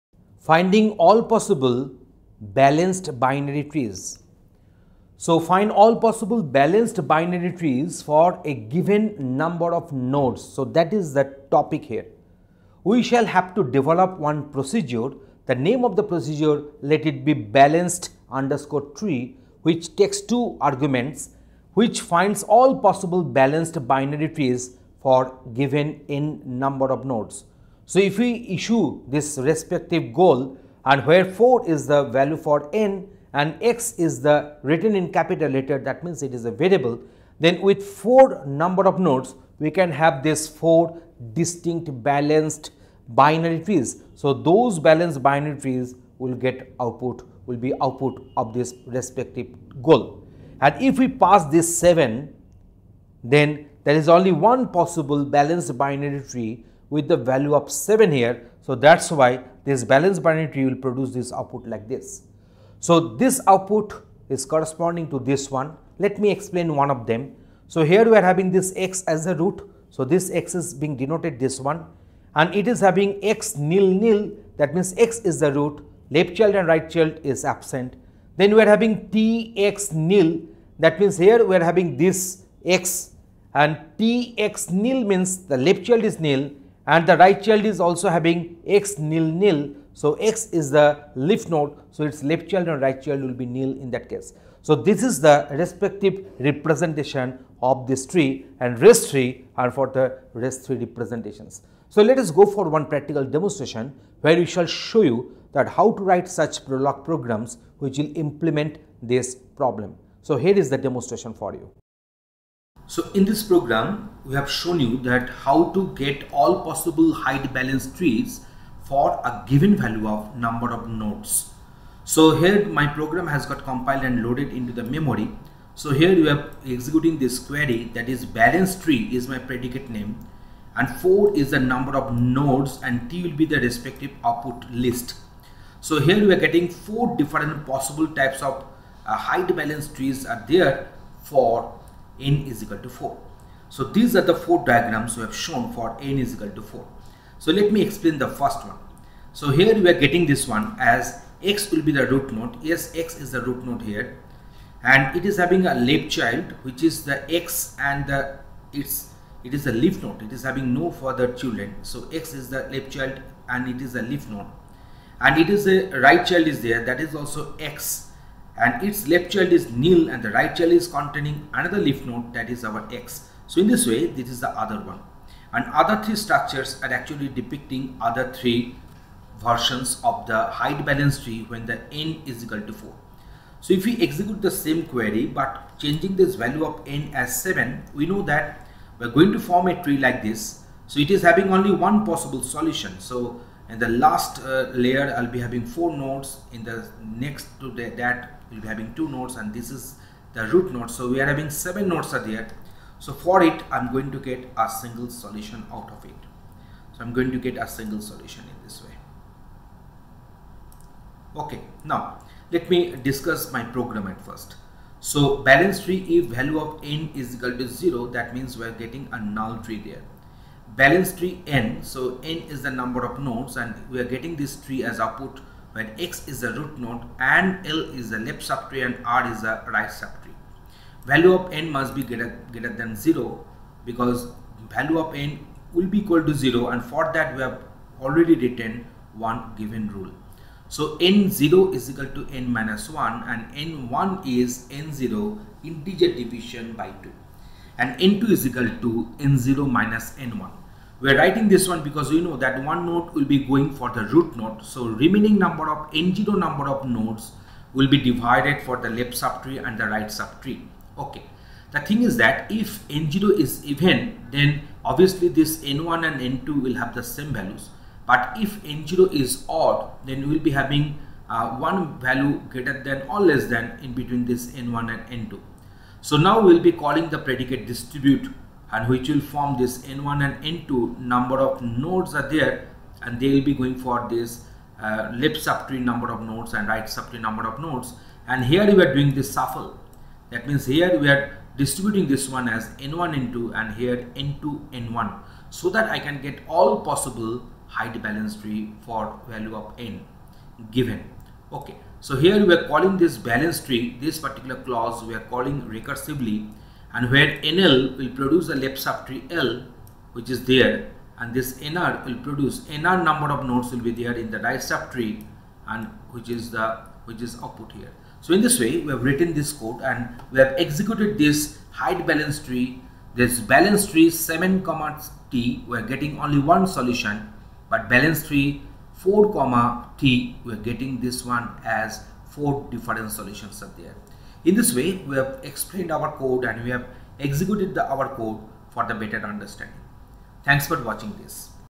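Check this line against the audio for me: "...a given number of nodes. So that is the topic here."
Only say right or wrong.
right.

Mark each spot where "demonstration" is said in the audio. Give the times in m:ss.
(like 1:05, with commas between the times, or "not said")
1:43, 1:50.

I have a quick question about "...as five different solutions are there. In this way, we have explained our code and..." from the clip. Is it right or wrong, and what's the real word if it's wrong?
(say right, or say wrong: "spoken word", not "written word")
wrong: "four", not "five".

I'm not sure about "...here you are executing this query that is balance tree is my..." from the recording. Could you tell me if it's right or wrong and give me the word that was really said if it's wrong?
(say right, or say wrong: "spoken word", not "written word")
right.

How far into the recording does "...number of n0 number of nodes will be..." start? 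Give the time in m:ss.
4:15.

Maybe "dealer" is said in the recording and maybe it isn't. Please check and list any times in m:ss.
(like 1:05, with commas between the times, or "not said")
not said.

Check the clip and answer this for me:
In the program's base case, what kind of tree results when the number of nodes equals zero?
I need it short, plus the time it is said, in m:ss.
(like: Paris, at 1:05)
null tree, at 3:39.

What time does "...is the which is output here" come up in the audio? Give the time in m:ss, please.
5:16.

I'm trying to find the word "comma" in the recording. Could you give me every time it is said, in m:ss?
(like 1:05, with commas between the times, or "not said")
5:24, 5:29.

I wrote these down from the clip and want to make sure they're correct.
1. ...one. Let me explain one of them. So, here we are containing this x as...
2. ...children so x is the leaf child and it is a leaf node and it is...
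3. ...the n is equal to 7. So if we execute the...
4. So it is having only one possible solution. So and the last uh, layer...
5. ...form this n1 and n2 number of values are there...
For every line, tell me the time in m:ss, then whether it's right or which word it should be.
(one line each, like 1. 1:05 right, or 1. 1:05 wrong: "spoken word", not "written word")
1. 1:05 wrong: "having", not "containing"
2. 2:41 right
3. 3:01 wrong: "4", not "7"
4. 3:10 right
5. 4:39 wrong: "nodes", not "values".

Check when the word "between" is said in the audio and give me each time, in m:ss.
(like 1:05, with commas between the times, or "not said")
4:33.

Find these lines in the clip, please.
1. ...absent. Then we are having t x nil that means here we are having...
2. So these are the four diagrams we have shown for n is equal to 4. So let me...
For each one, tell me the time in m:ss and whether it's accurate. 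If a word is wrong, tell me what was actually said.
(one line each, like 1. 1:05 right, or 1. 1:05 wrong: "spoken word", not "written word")
1. 1:17 right
2. 2:23 right.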